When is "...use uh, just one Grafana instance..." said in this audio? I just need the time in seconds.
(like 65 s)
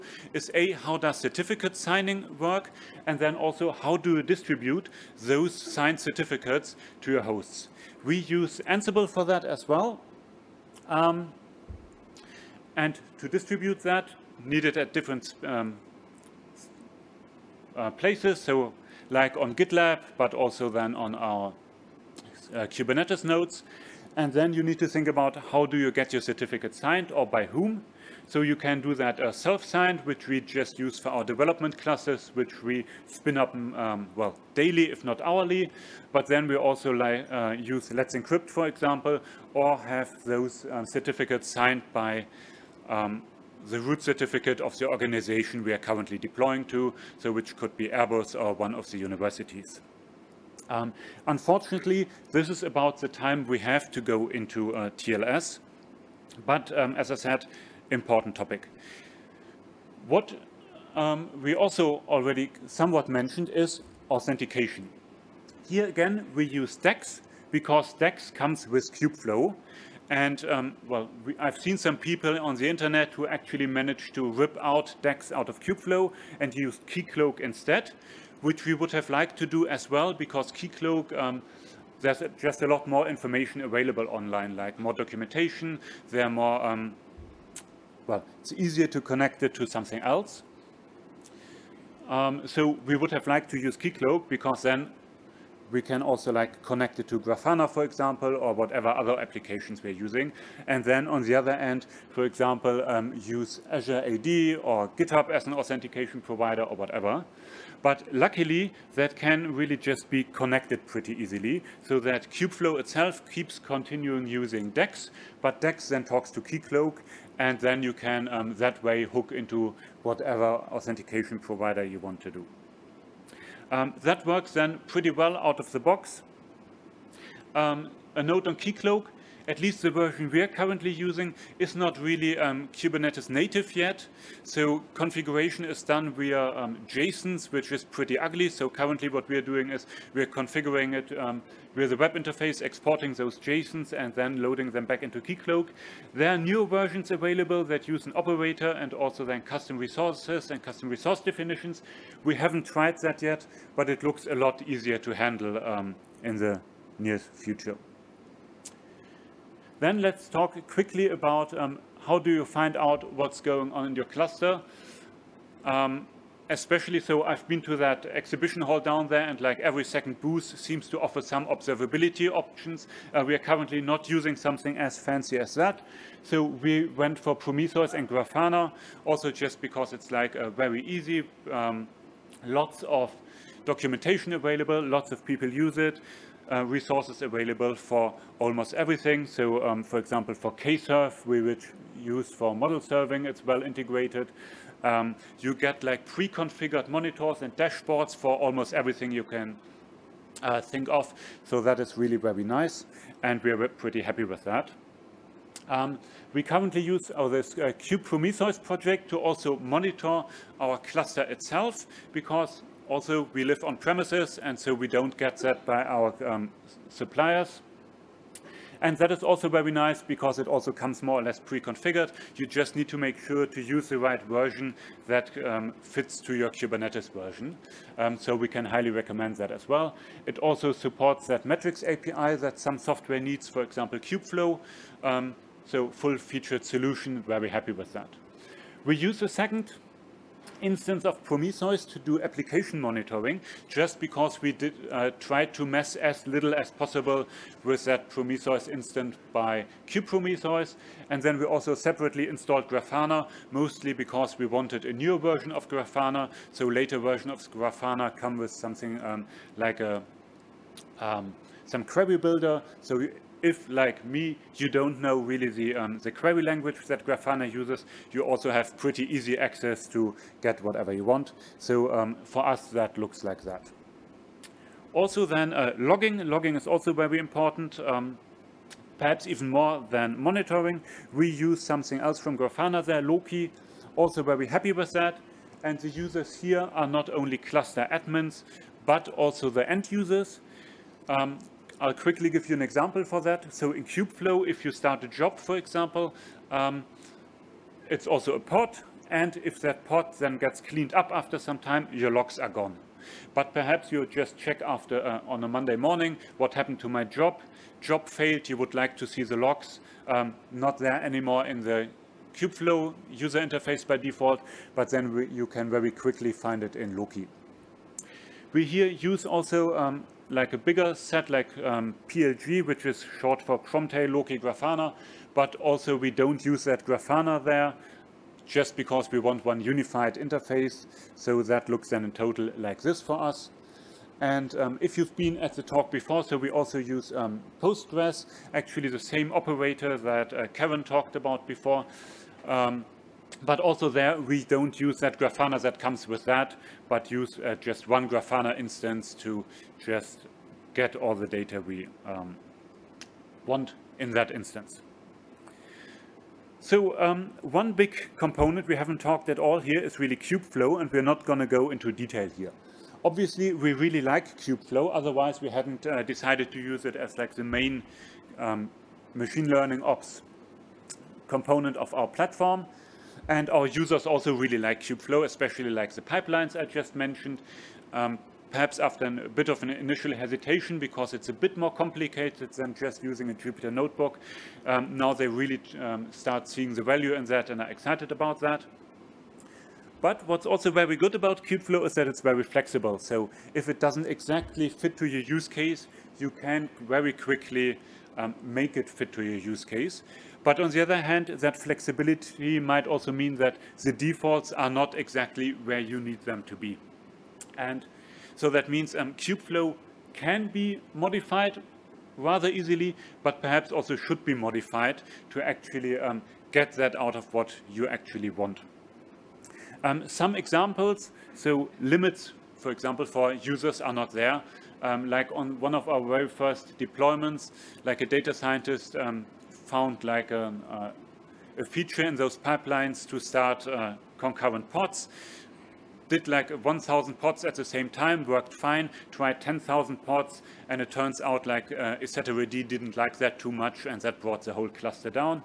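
347 s.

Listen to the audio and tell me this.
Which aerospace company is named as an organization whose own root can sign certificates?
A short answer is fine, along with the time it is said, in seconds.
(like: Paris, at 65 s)
Airbus, at 47 s.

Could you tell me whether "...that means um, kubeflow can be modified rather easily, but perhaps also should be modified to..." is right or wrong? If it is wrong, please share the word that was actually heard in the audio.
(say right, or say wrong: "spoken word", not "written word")
right.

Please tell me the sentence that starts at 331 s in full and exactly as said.
So that looks then in total like this for us.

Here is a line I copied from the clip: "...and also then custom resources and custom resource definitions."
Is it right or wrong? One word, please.
right.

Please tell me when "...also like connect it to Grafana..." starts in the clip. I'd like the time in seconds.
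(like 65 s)
96 s.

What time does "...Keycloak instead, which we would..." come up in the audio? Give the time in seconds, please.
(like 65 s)
76 s.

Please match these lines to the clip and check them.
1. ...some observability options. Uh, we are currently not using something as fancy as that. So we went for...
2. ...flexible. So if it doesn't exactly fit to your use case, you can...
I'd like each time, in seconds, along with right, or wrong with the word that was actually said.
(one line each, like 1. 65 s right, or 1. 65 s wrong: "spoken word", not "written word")
1. 171 s right
2. 392 s right.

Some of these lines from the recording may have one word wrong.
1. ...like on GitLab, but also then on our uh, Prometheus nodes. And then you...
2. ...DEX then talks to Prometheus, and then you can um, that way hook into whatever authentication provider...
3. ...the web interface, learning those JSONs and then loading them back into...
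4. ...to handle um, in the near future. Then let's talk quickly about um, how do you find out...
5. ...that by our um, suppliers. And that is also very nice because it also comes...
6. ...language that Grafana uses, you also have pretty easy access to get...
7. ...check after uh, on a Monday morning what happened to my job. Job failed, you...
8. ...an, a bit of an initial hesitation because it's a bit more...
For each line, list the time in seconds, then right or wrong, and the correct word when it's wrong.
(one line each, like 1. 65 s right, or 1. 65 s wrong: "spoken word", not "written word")
1. 19 s wrong: "Kubernetes", not "Prometheus"
2. 115 s wrong: "Keycloak", not "Prometheus"
3. 141 s wrong: "exporting", not "learning"
4. 154 s right
5. 215 s right
6. 266 s right
7. 304 s right
8. 379 s right.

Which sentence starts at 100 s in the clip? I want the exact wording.
And then on the other end, for example, um, use Azure AD or GitHub as an authentication provider or whatever.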